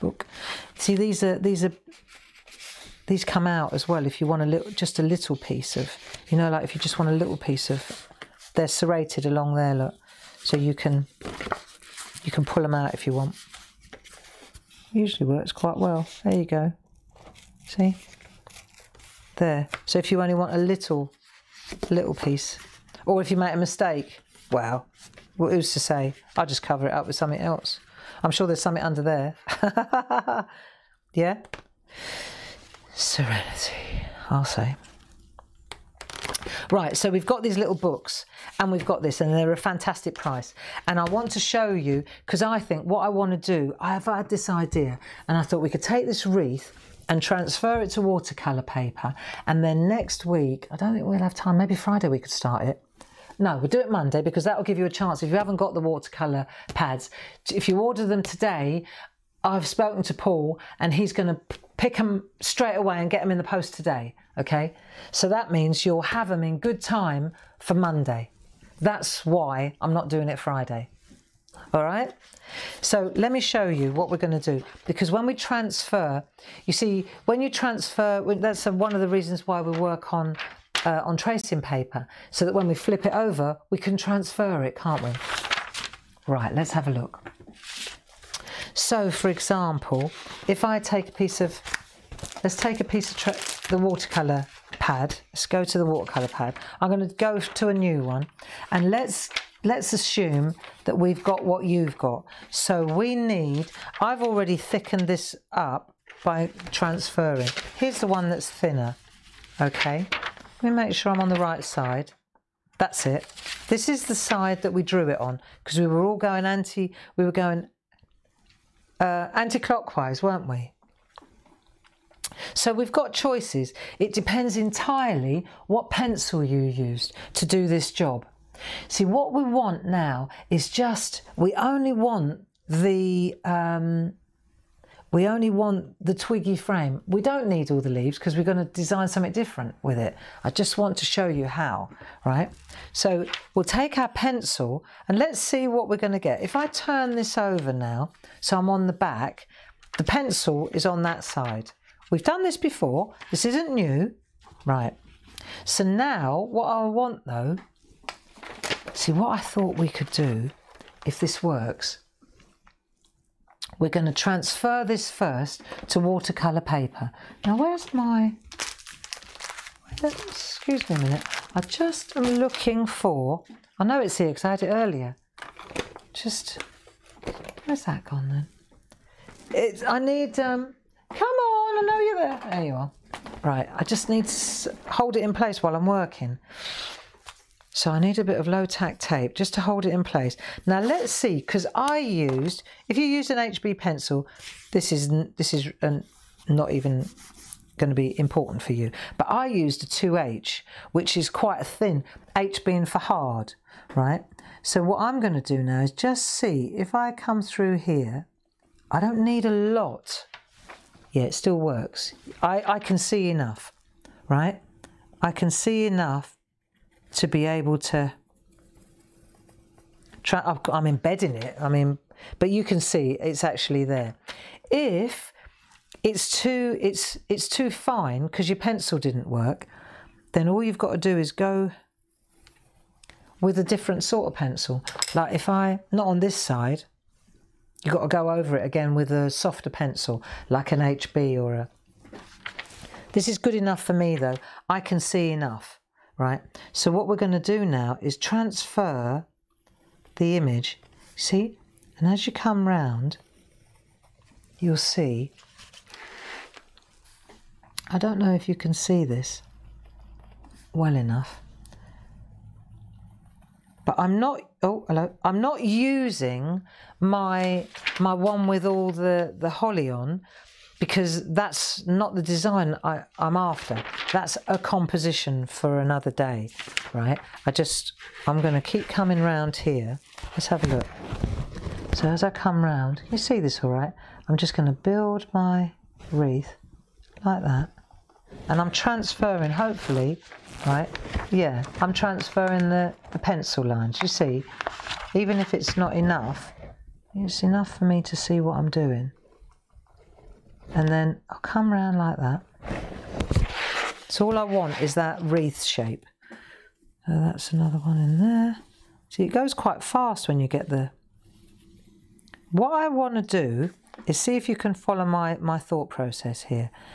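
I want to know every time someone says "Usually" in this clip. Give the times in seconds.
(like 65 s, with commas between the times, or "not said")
14 s.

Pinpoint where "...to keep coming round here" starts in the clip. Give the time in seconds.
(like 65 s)
278 s.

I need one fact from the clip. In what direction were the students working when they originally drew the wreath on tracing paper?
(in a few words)
Anti-clockwise.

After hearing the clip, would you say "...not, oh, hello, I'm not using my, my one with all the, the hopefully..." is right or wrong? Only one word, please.
wrong.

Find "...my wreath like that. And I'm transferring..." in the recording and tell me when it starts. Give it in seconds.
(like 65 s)
285 s.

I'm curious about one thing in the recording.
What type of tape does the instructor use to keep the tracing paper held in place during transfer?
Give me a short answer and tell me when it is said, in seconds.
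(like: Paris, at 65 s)
Low tack tape, at 188 s.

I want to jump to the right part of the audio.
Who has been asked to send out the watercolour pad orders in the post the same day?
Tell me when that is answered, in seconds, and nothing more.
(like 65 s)
60 s.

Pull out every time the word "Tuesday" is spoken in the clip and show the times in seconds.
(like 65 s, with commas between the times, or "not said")
not said.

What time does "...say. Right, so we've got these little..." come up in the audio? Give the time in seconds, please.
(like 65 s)
34 s.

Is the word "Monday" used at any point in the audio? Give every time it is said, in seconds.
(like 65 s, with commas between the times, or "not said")
53 s, 67 s.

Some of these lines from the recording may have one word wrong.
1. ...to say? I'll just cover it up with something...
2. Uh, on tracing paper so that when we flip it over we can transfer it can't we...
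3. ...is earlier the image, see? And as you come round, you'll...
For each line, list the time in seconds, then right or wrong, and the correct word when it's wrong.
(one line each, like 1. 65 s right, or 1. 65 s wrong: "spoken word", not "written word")
1. 25 s right
2. 80 s right
3. 247 s wrong: "transfer", not "earlier".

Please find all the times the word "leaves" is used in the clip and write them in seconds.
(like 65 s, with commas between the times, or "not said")
137 s.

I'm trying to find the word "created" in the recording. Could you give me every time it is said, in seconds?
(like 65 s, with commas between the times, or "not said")
not said.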